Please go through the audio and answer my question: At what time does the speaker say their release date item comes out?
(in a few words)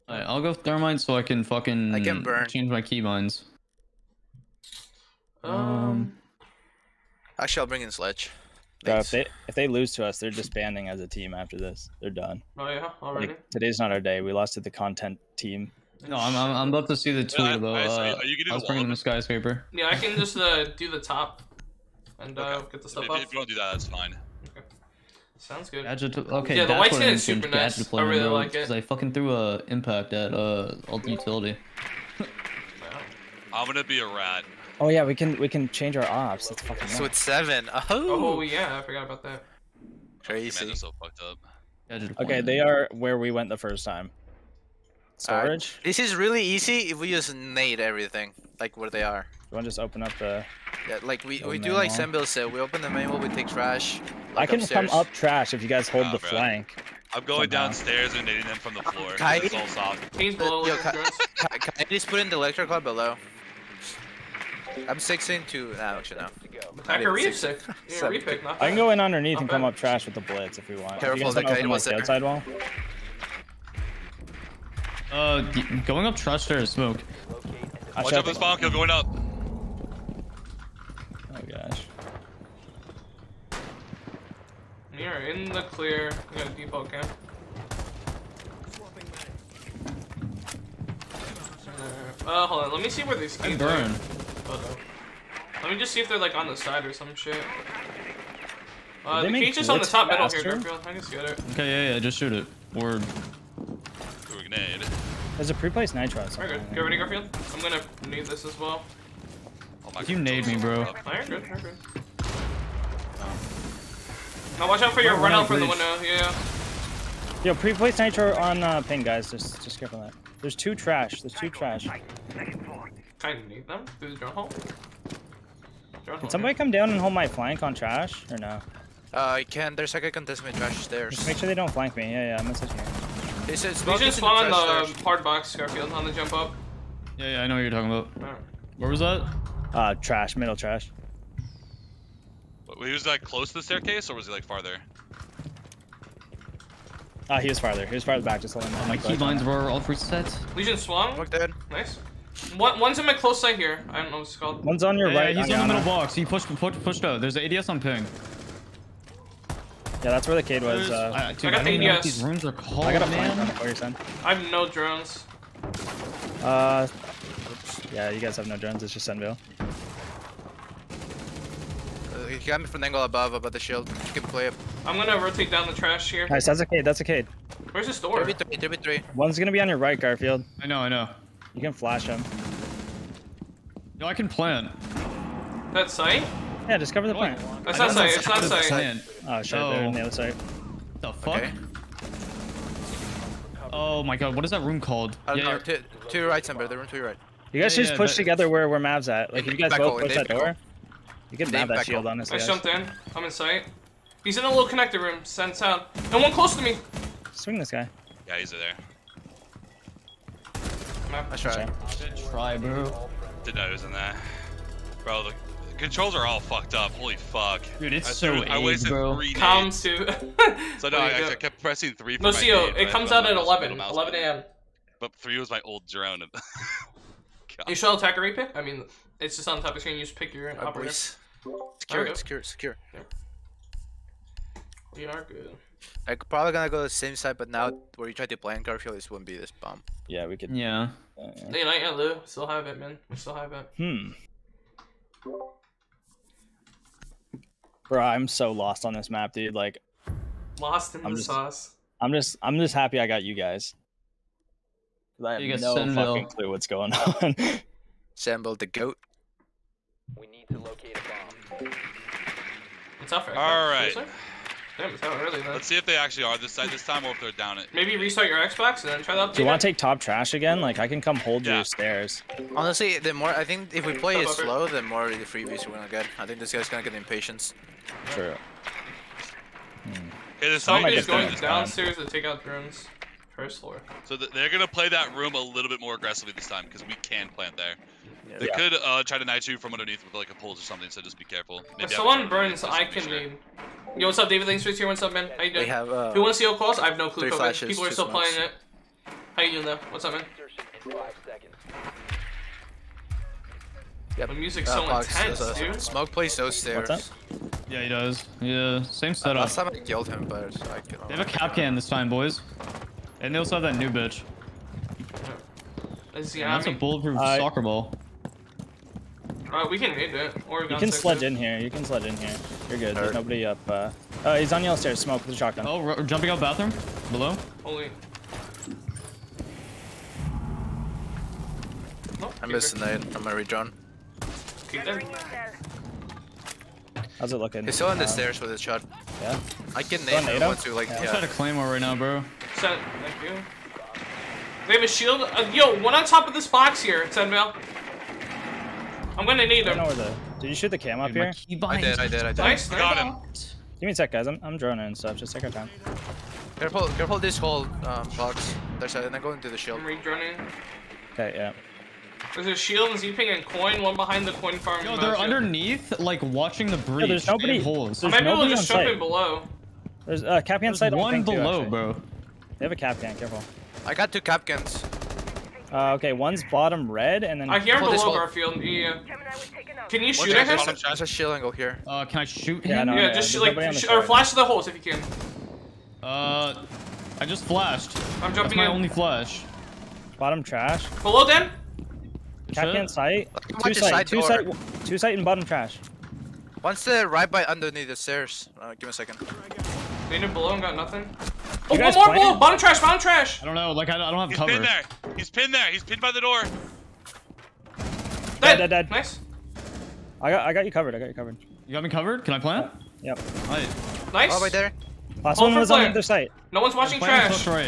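11 a.m.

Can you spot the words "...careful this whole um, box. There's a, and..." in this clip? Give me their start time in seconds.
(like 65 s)
356 s.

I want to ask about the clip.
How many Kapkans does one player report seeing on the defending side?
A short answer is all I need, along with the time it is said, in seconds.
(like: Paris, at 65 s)
2, at 374 s.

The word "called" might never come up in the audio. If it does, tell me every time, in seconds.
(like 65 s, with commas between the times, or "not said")
154 s, 194 s.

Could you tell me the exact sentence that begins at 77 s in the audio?
Watch out this bomb kill going up.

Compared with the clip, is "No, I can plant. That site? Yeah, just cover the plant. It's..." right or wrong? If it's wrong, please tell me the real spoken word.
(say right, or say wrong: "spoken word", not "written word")
right.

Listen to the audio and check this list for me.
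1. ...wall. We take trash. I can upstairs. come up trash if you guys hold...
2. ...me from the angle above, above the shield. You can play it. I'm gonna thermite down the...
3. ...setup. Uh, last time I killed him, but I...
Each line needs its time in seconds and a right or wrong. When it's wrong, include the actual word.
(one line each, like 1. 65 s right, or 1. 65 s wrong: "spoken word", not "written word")
1. 53 s right
2. 172 s wrong: "rotate", not "thermite"
3. 309 s right.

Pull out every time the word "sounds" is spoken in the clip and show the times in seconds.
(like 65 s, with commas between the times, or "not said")
25 s, 205 s.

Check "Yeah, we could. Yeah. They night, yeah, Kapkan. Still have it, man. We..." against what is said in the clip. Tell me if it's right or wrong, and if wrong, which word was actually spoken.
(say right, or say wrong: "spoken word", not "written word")
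wrong: "Lou", not "Kapkan".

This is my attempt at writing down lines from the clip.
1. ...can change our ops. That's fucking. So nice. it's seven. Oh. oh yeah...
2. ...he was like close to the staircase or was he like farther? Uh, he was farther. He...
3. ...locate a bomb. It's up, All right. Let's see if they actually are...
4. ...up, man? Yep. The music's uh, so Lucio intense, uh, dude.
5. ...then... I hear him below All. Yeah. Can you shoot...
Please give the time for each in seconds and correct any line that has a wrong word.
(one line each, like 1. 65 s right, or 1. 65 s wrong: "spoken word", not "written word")
1. 35 s right
2. 142 s right
3. 260 s right
4. 300 s wrong: "Fox", not "Lucio"
5. 377 s wrong: "Garfield", not "All".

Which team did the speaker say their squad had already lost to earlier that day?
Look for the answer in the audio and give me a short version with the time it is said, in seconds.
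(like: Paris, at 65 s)
the content team, at 14 s.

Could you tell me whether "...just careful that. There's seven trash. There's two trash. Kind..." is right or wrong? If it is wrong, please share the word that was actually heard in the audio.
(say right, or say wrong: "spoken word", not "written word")
wrong: "two", not "seven".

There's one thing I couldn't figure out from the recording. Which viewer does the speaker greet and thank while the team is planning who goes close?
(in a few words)
David.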